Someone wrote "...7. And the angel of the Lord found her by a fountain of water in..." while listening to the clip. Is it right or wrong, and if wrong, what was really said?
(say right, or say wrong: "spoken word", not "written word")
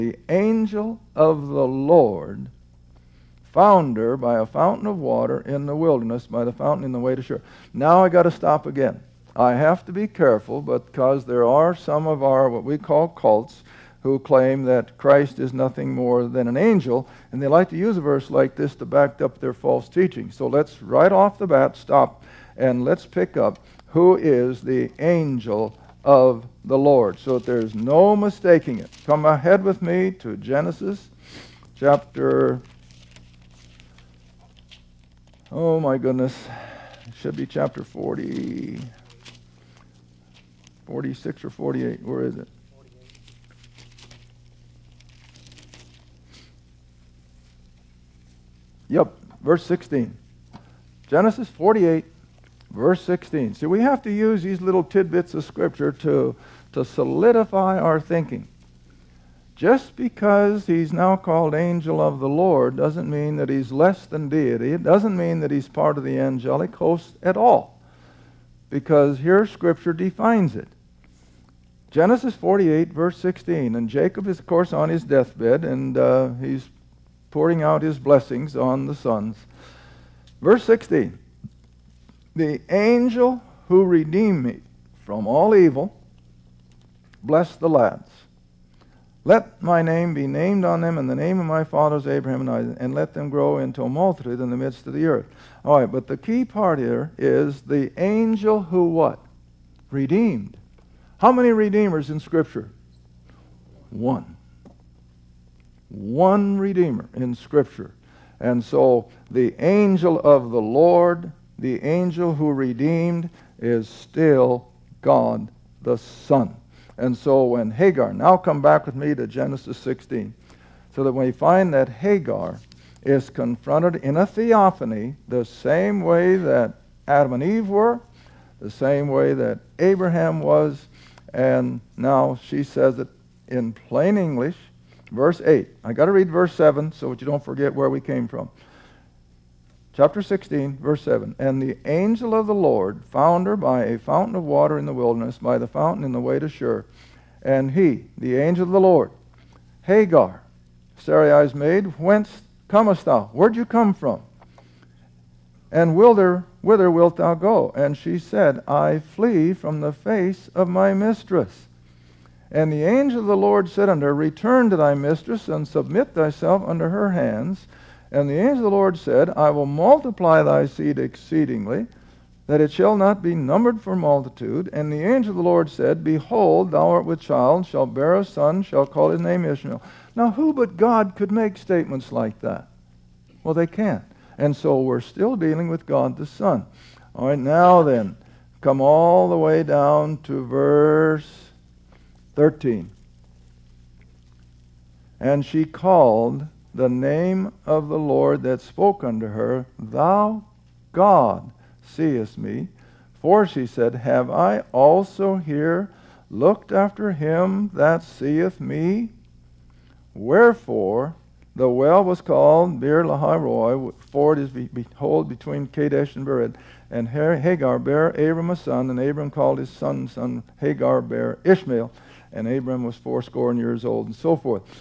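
right.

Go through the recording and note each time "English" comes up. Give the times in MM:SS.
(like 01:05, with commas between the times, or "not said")
02:14.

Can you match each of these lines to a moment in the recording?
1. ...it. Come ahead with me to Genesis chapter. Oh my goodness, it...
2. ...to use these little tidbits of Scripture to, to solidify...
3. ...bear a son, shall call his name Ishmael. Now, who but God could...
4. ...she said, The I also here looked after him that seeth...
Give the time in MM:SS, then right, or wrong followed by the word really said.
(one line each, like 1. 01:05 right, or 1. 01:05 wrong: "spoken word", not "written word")
1. 00:28 right
2. 00:54 right
3. 02:57 right
4. 03:23 wrong: "Have", not "The".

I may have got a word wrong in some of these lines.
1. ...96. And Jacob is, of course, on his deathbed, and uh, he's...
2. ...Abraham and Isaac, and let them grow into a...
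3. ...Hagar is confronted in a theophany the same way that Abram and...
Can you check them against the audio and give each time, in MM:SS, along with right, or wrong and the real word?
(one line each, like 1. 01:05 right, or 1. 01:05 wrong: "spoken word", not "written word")
1. 01:13 wrong: "16", not "96"
2. 01:32 right
3. 02:01 wrong: "Adam", not "Abram".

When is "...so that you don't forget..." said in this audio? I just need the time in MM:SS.
02:16.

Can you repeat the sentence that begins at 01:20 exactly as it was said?
Verse 16 The angel who redeemed me from all evil blessed the lads.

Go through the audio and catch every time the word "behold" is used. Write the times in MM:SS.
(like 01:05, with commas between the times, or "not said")
02:56, 03:34.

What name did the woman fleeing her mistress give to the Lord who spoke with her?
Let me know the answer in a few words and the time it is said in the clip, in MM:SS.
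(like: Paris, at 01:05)
Thou God seest me, at 03:19.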